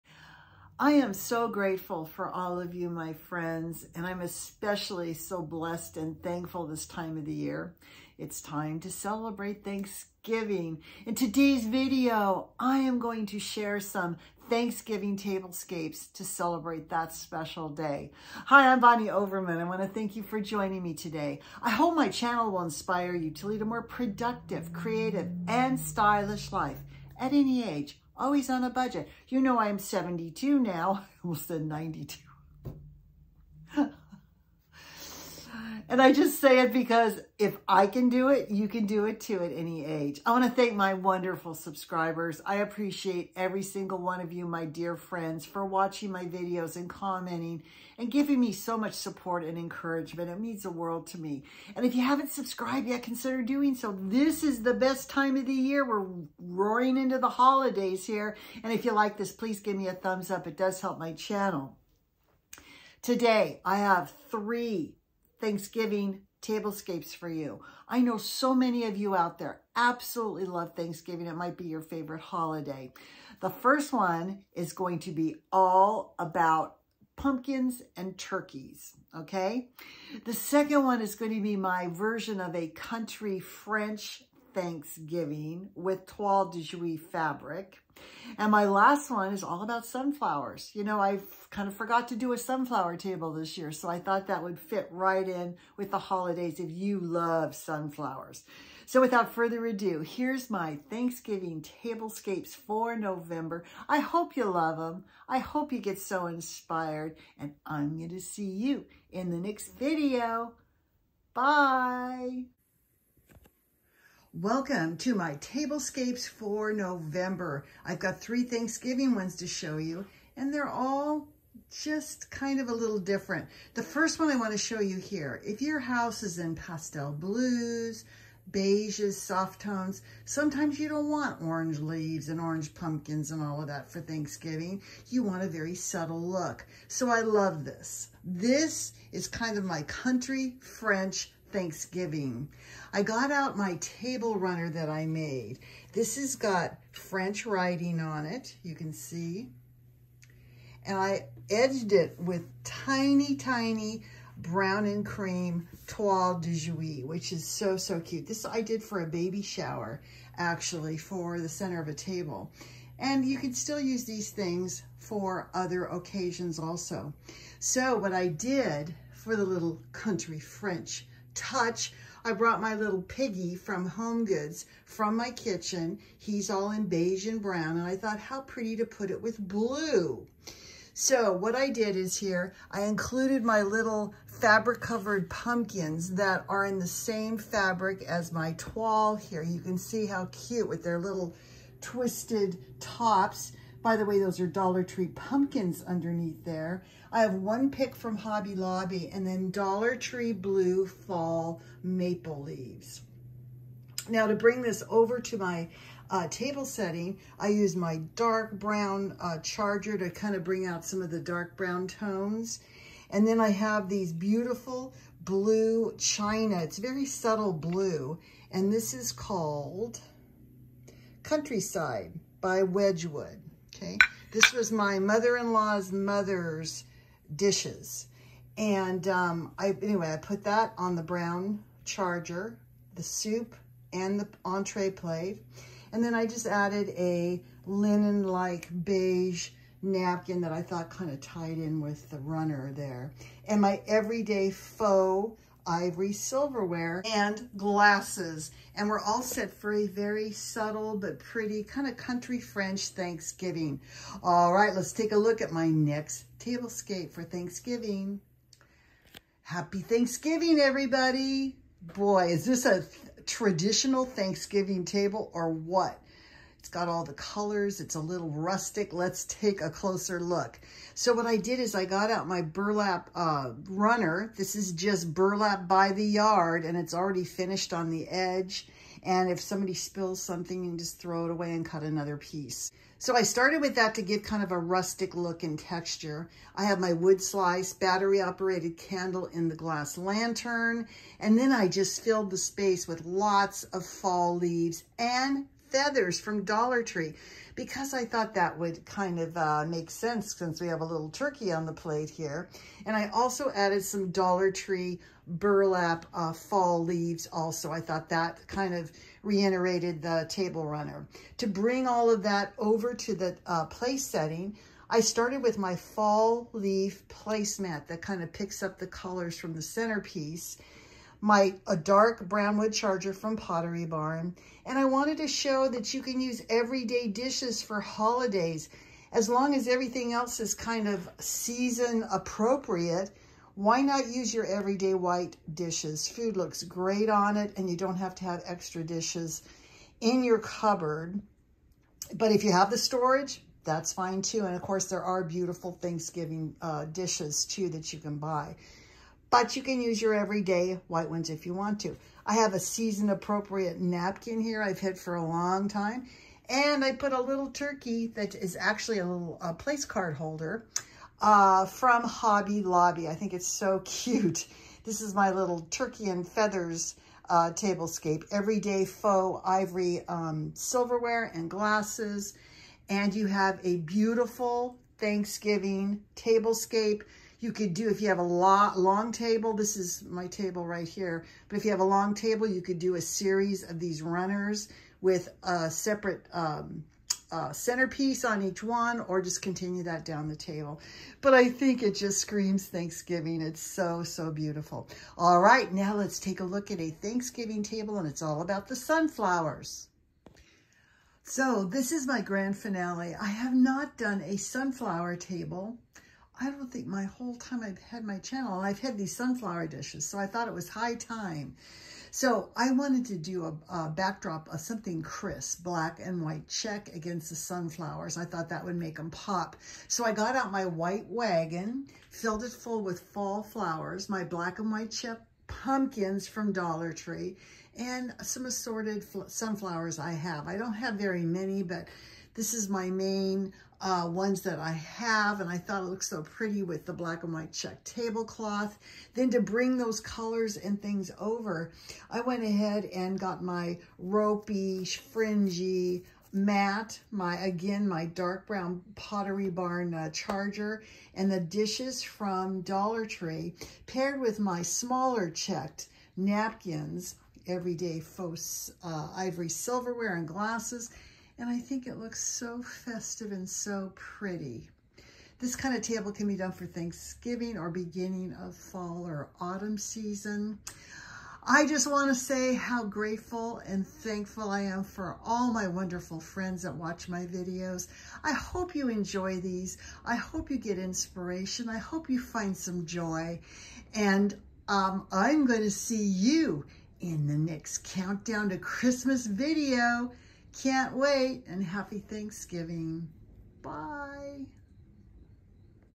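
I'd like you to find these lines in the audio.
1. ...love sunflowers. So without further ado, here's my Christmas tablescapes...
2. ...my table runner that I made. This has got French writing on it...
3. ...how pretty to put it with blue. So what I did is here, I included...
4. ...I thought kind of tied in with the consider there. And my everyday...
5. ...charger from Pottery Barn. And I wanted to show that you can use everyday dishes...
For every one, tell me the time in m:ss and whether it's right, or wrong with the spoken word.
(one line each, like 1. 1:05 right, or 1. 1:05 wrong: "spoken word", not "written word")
1. 1:36 wrong: "Thanksgiving", not "Christmas"
2. 2:23 right
3. 2:58 right
4. 4:00 wrong: "runner", not "consider"
5. 5:22 right.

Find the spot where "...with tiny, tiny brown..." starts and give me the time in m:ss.
2:32.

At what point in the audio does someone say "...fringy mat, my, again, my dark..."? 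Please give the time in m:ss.
7:24.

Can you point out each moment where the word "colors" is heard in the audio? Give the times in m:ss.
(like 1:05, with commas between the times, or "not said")
4:27, 5:18, 7:19.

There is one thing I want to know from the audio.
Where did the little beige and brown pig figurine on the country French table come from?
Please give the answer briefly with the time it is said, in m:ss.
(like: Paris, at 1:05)
Home Goods, at 2:53.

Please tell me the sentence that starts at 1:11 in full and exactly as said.
It might be your favorite holiday.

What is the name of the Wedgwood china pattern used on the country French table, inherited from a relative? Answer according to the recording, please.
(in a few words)
Countryside.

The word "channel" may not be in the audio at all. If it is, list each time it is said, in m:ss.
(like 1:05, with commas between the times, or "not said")
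0:22, 1:01, 6:48.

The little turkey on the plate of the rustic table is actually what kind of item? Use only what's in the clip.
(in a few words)
a place card holder.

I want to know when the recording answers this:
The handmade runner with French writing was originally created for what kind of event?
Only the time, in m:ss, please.
2:39.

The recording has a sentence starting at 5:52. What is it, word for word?
I have a season-appropriate napkin here I've had for a long time.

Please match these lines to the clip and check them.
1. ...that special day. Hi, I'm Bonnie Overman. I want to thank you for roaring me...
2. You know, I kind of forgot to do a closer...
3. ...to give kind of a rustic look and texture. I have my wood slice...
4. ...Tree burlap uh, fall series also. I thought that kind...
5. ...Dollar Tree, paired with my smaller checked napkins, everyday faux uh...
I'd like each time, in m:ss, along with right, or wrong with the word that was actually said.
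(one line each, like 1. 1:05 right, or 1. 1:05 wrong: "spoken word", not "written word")
1. 0:16 wrong: "joining", not "roaring"
2. 1:30 wrong: "sunflower", not "closer"
3. 4:43 right
4. 5:04 wrong: "leaves", not "series"
5. 7:32 right.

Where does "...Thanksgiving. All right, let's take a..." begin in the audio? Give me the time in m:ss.
4:12.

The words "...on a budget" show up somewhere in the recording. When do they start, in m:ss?
0:28.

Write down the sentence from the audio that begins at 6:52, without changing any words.
So I wanted to do a, a, backdrop of something crisp, black and white check against the sunflowers.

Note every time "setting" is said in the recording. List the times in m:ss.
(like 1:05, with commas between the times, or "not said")
3:26, 5:14.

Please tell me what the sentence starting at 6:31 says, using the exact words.
But I think it just screams Thanksgiving.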